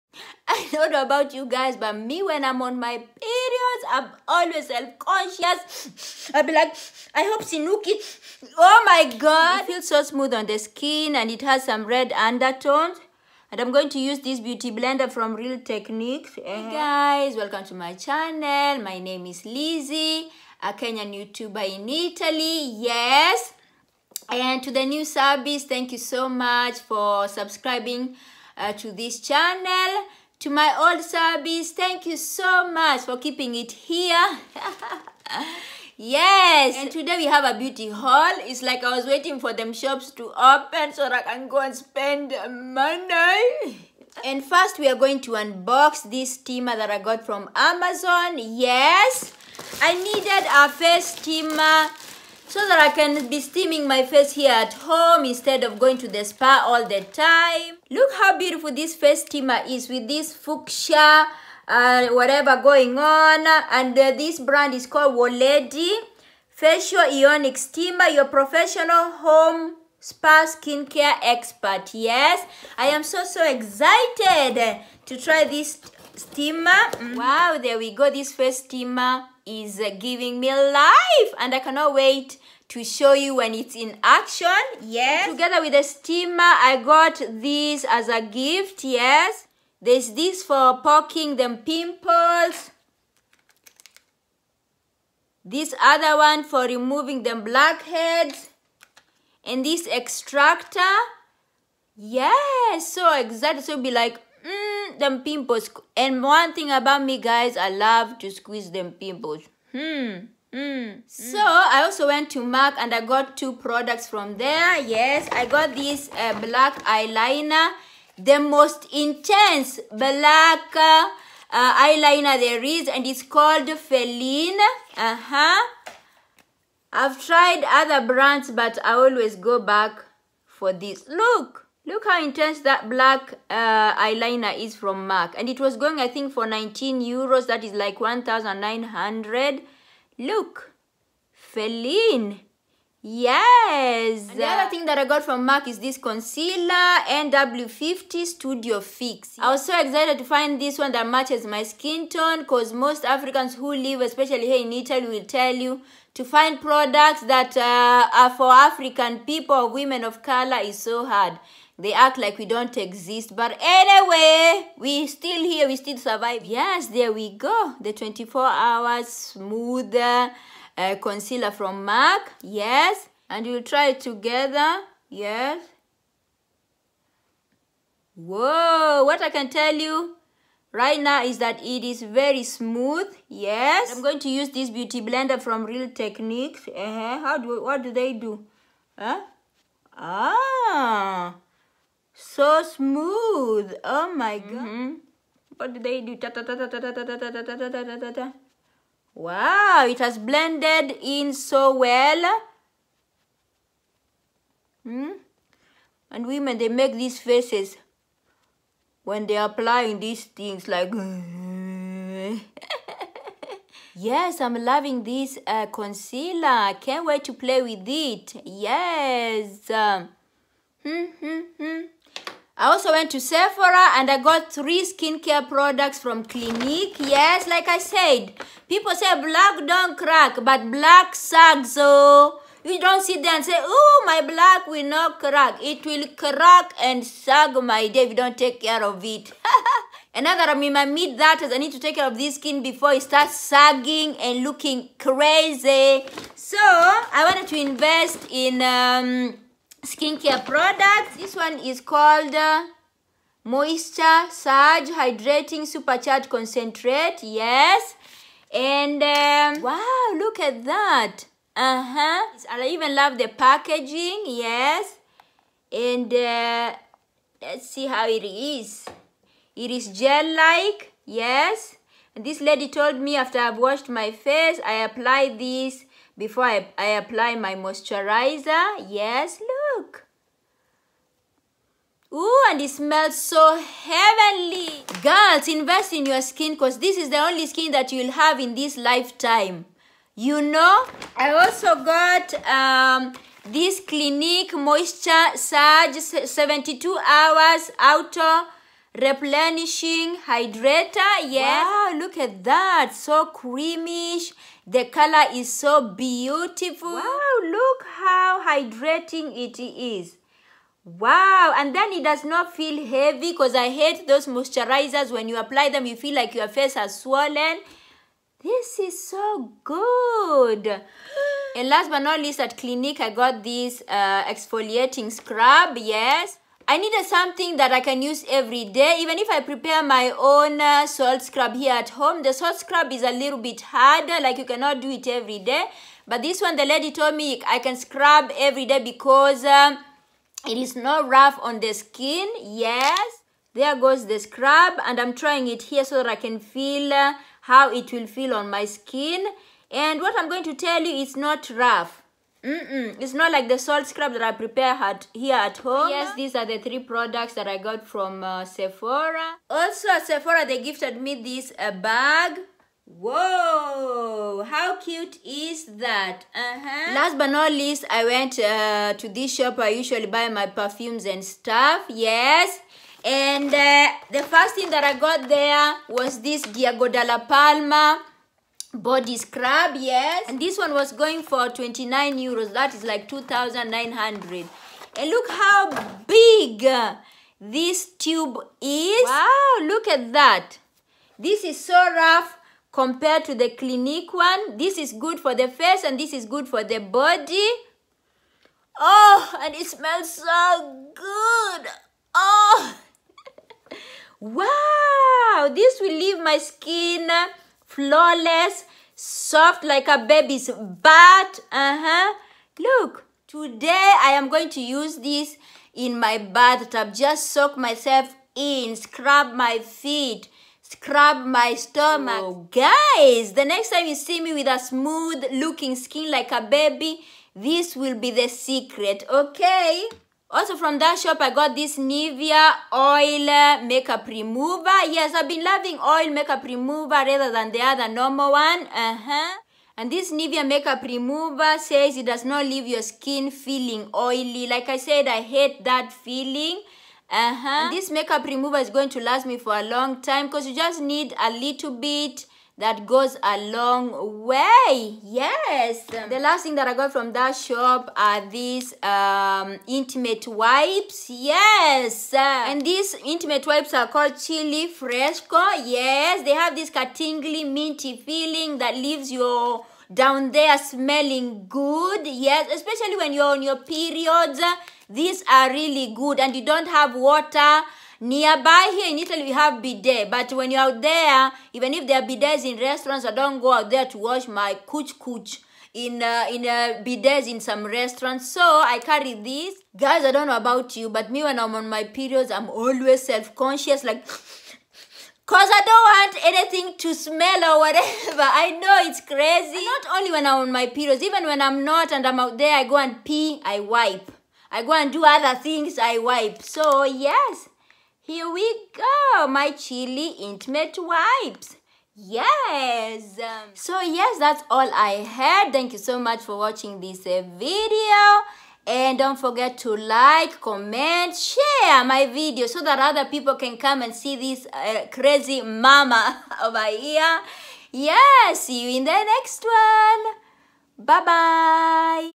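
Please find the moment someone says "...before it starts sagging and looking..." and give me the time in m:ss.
4:02.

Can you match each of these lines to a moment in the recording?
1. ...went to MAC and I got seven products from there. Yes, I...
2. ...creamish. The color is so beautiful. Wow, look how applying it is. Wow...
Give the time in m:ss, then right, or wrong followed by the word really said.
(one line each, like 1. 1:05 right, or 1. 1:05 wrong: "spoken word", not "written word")
1. 1:52 wrong: "two", not "seven"
2. 5:03 wrong: "hydrating", not "applying".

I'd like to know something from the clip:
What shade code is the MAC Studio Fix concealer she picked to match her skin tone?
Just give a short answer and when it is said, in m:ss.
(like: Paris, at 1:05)
NW50, at 2:27.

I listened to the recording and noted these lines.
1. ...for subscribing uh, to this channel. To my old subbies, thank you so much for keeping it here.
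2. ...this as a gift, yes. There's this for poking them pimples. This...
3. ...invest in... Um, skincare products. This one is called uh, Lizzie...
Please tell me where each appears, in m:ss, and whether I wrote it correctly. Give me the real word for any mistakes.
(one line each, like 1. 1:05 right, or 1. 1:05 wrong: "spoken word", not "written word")
1. 0:26 right
2. 1:27 right
3. 4:07 wrong: "Moisture", not "Lizzie".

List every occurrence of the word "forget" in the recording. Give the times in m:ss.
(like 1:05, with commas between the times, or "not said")
8:39.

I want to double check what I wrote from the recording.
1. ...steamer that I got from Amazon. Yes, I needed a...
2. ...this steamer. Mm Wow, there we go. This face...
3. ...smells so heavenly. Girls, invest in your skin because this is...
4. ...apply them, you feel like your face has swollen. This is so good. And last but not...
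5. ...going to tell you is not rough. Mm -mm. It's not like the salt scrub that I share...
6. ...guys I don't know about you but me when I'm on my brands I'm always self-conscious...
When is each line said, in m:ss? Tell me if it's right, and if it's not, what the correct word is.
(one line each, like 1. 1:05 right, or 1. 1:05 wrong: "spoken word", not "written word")
1. 0:46 right
2. 1:15 right
3. 4:42 right
4. 5:15 right
5. 5:50 wrong: "prepare", not "share"
6. 8:09 wrong: "periods", not "brands".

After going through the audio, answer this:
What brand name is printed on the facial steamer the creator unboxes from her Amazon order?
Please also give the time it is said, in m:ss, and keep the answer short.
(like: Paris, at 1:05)
Woledi, at 1:05.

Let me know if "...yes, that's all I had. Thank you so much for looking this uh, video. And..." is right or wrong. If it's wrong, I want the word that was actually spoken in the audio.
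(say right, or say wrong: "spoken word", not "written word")
wrong: "watching", not "looking".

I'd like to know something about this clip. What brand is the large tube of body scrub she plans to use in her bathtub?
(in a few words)
Diego dalla Palma.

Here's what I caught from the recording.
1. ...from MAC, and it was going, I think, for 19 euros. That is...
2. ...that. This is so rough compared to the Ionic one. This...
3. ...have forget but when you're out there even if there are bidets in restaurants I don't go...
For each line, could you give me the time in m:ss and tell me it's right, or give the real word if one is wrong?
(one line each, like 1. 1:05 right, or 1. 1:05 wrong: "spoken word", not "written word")
1. 2:14 right
2. 6:30 wrong: "Clinique", not "Ionic"
3. 7:59 wrong: "bidet", not "forget".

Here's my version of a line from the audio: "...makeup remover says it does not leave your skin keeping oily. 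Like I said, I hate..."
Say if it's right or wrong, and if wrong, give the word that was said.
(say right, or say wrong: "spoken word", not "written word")
wrong: "feeling", not "keeping".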